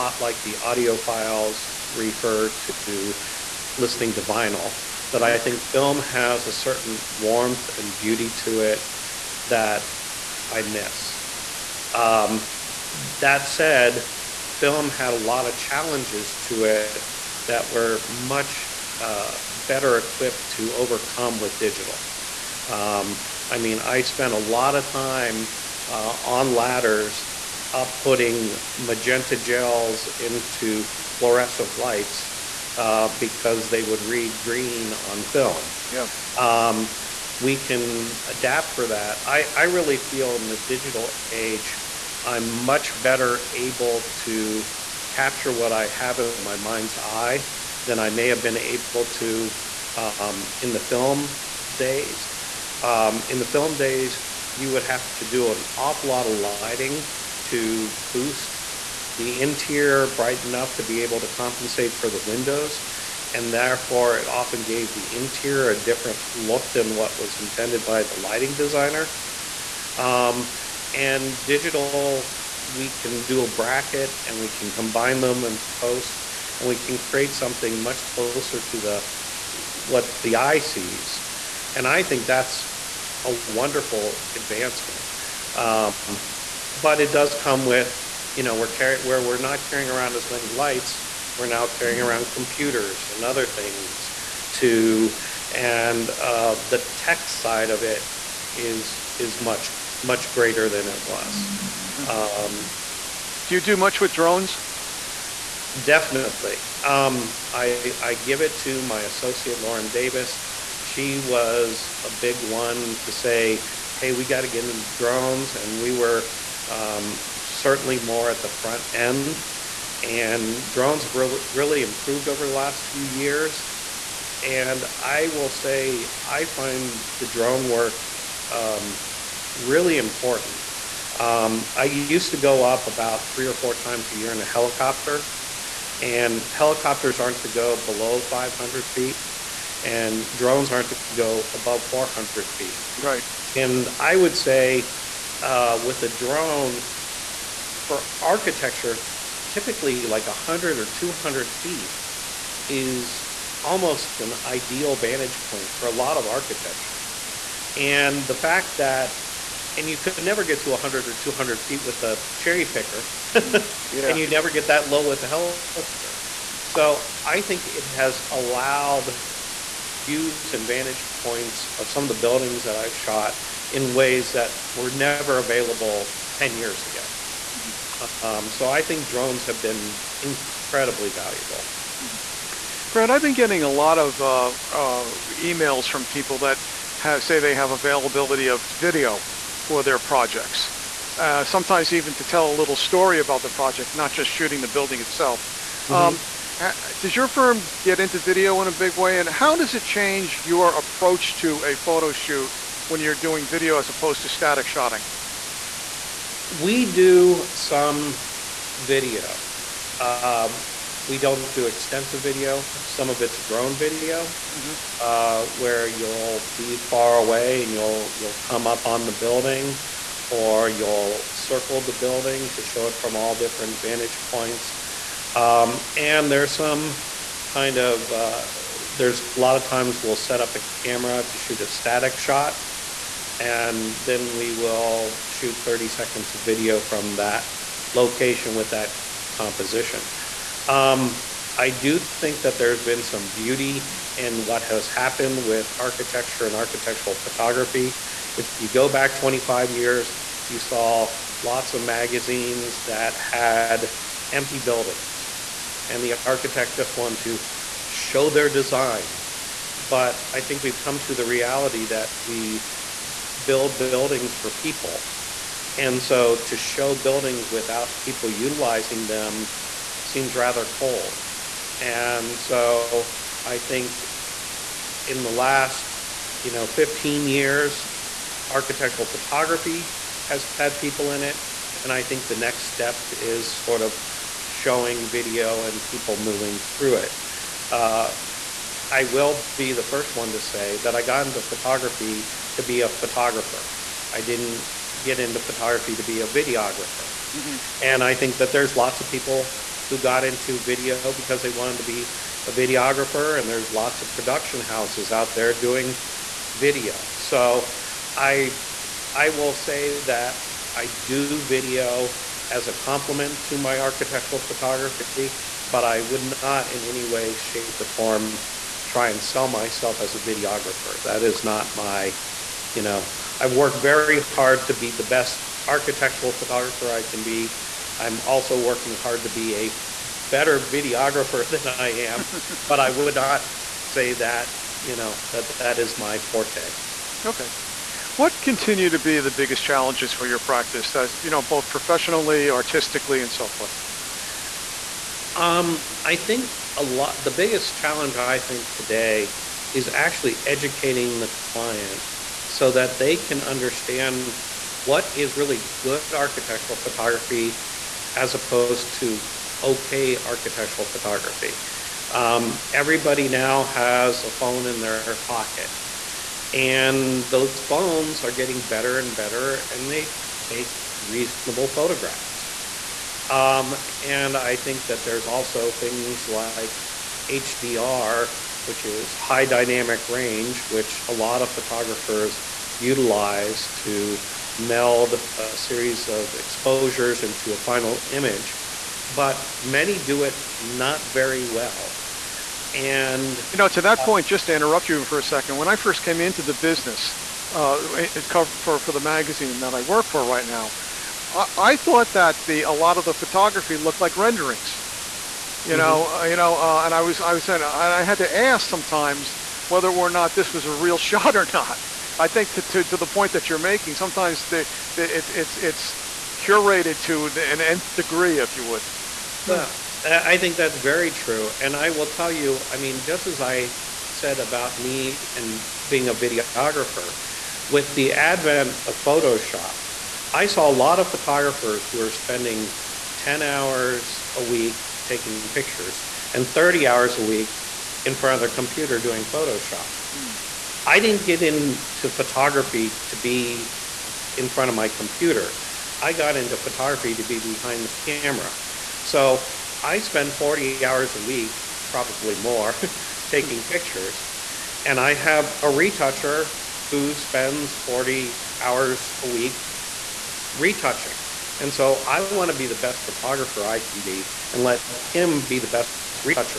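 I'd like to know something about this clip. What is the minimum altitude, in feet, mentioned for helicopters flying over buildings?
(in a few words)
500 feet.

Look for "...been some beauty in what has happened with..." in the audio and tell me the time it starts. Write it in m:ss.
4:02.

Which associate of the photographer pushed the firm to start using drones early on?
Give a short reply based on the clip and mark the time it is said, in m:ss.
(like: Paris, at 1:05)
Lauren Davis, at 1:49.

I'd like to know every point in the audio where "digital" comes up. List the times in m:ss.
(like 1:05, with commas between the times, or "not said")
0:21, 0:40, 1:11.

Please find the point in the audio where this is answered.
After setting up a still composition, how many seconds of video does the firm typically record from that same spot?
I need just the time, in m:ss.
3:55.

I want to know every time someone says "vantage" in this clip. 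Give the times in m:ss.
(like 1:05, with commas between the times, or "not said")
2:34, 2:50, 3:43.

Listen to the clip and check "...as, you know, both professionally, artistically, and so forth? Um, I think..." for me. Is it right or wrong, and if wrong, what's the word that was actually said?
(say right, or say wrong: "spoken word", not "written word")
right.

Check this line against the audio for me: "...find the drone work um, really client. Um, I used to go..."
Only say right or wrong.
wrong.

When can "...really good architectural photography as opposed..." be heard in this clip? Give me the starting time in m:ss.
5:55.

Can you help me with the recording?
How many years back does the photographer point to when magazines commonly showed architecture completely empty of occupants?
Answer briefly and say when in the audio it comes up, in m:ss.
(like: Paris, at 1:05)
25 years, at 4:09.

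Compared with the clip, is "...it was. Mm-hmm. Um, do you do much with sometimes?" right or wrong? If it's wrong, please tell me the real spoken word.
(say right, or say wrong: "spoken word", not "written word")
wrong: "drones", not "sometimes".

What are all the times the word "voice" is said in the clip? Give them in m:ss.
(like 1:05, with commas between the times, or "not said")
not said.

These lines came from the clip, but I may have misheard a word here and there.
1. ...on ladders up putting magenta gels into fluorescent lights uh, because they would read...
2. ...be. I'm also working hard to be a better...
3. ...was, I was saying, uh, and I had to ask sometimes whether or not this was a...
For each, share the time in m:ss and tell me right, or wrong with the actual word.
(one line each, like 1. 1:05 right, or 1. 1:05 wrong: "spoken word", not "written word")
1. 0:26 right
2. 5:27 right
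3. 6:47 right.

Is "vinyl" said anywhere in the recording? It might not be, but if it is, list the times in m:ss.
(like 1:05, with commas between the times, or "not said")
0:04.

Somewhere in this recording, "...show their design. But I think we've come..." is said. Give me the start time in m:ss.
4:17.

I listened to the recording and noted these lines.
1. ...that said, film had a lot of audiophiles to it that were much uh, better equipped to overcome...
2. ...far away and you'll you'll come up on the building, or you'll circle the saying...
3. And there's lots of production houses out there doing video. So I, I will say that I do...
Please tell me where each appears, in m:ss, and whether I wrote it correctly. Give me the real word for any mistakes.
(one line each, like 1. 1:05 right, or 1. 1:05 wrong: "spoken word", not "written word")
1. 0:13 wrong: "challenges", not "audiophiles"
2. 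3:36 wrong: "building", not "saying"
3. 5:03 right.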